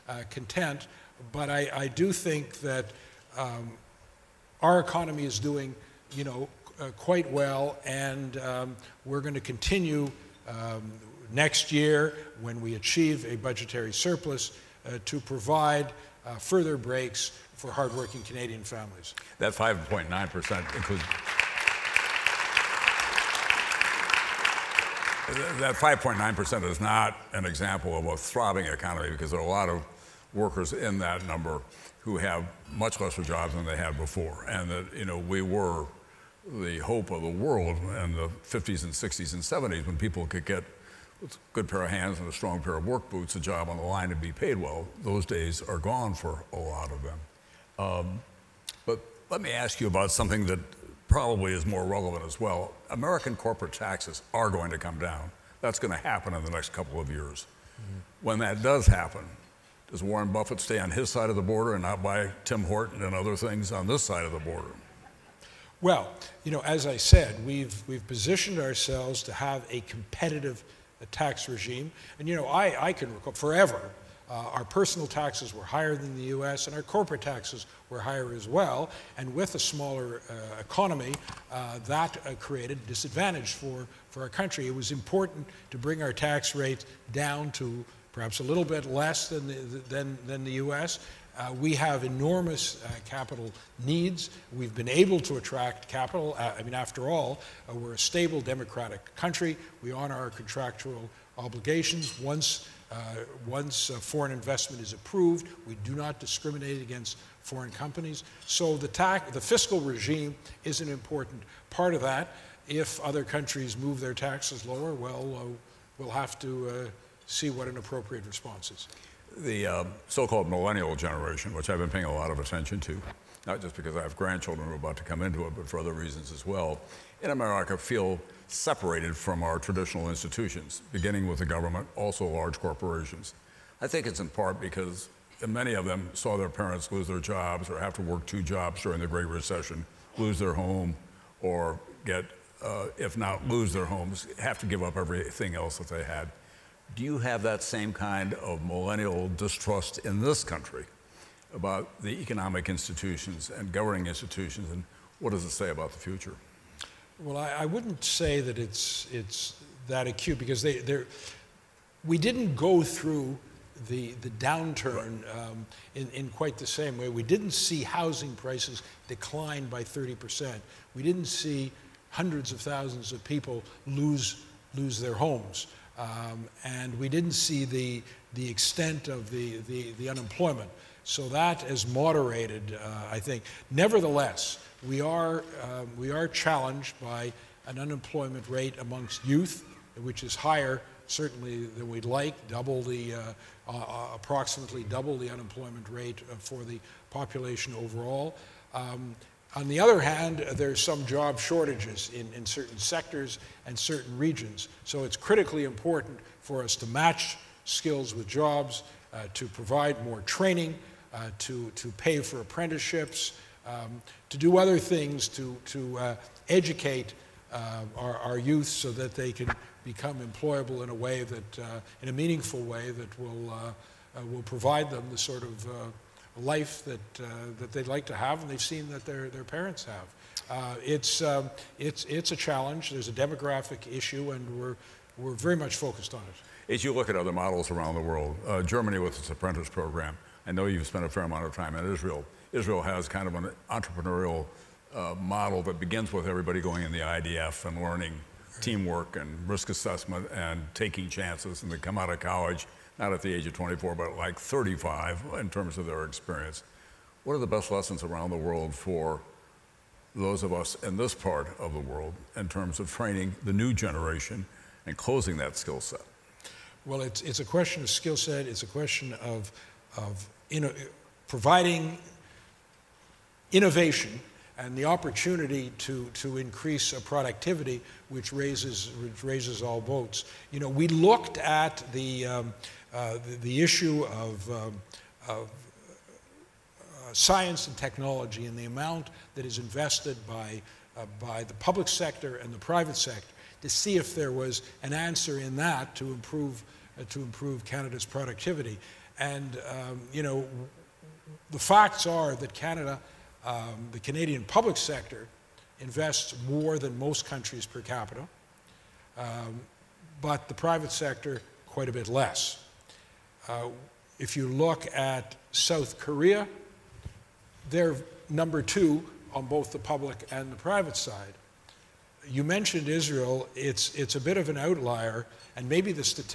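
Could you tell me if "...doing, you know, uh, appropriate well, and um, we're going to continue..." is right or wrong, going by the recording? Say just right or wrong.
wrong.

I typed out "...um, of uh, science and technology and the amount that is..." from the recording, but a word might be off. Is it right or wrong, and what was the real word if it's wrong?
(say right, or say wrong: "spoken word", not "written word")
right.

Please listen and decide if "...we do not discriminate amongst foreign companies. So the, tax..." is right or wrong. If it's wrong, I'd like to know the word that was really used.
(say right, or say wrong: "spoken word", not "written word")
wrong: "against", not "amongst".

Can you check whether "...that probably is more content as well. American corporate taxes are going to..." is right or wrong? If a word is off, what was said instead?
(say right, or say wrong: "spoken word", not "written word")
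wrong: "relevant", not "content".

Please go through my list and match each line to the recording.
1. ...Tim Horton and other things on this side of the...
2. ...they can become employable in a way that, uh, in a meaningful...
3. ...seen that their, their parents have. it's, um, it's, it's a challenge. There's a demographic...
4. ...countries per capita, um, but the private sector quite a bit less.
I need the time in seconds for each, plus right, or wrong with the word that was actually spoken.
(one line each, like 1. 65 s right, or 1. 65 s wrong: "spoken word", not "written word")
1. 62 s right
2. 219 s right
3. 228 s right
4. 307 s right.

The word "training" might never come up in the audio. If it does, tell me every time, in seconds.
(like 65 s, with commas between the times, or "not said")
210 s, 262 s.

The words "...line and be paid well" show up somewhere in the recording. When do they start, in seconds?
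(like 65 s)
43 s.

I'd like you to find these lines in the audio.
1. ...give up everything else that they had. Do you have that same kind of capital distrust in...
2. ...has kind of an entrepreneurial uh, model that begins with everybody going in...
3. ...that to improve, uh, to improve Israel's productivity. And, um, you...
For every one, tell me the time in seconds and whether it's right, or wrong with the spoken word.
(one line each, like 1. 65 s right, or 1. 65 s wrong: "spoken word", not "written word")
1. 144 s wrong: "millennial", not "capital"
2. 242 s right
3. 295 s wrong: "Canada", not "Israel".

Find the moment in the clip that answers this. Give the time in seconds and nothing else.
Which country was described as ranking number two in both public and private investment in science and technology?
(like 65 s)
315 s.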